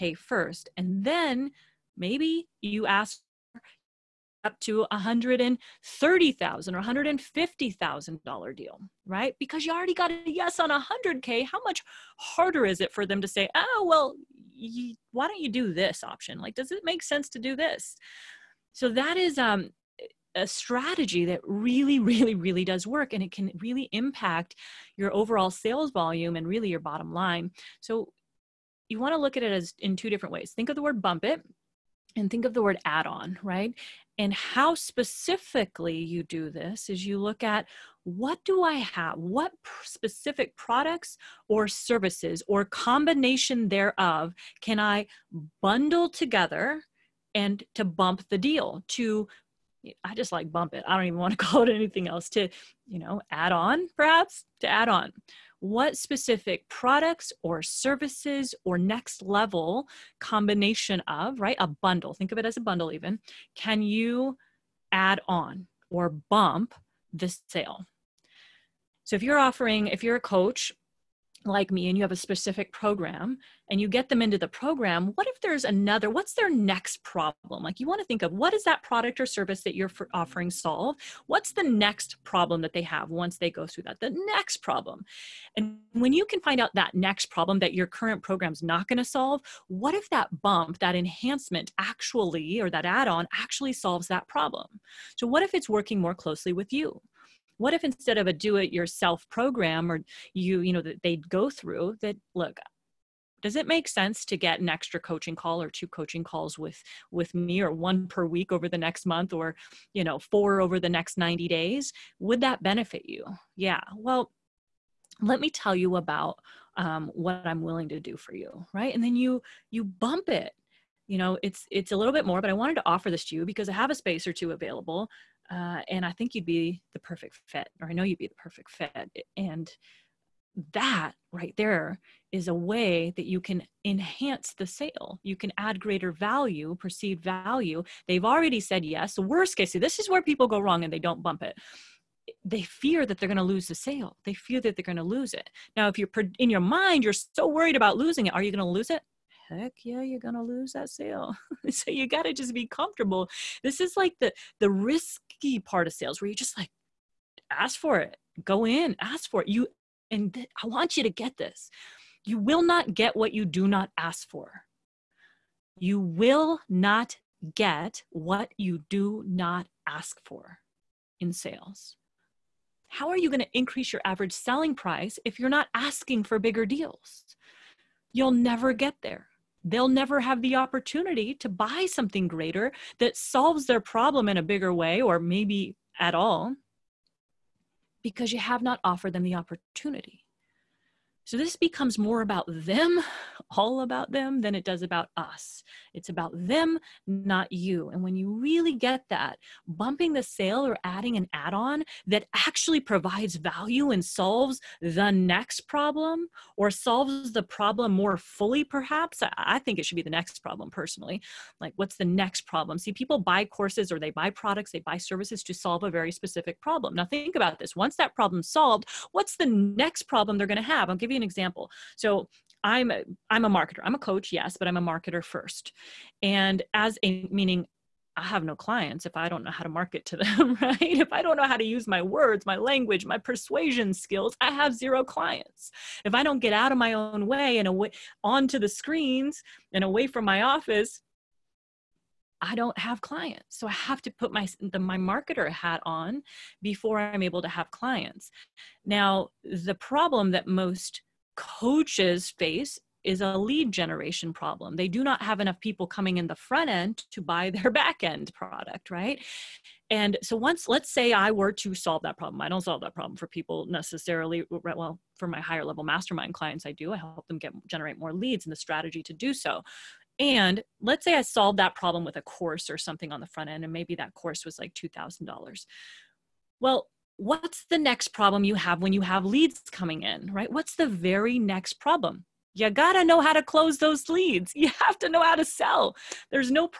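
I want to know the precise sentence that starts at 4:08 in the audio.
Now, the problem that most coaches face is a lead generation problem.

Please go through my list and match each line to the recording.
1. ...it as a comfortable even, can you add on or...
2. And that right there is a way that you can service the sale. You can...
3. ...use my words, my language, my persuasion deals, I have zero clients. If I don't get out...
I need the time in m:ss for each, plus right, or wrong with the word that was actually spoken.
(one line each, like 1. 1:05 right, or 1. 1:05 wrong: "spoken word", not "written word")
1. 1:02 wrong: "bundle", not "comfortable"
2. 2:09 wrong: "enhance", not "service"
3. 3:51 wrong: "skills", not "deals".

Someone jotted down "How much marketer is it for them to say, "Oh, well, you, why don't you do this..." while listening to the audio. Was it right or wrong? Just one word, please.
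wrong.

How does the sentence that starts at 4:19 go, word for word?
And so once let's say I were to solve that problem.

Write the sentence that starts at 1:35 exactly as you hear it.
So what if it's working more closely with you?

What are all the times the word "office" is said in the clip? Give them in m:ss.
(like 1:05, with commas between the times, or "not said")
4:00.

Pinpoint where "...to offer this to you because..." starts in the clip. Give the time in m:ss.
2:02.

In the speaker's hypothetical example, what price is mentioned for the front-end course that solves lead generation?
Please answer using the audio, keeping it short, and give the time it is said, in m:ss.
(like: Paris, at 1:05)
$2,000, at 4:34.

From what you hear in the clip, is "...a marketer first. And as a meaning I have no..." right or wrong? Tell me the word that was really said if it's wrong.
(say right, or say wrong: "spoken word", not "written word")
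right.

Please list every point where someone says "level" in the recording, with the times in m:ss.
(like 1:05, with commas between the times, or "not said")
0:59, 4:25.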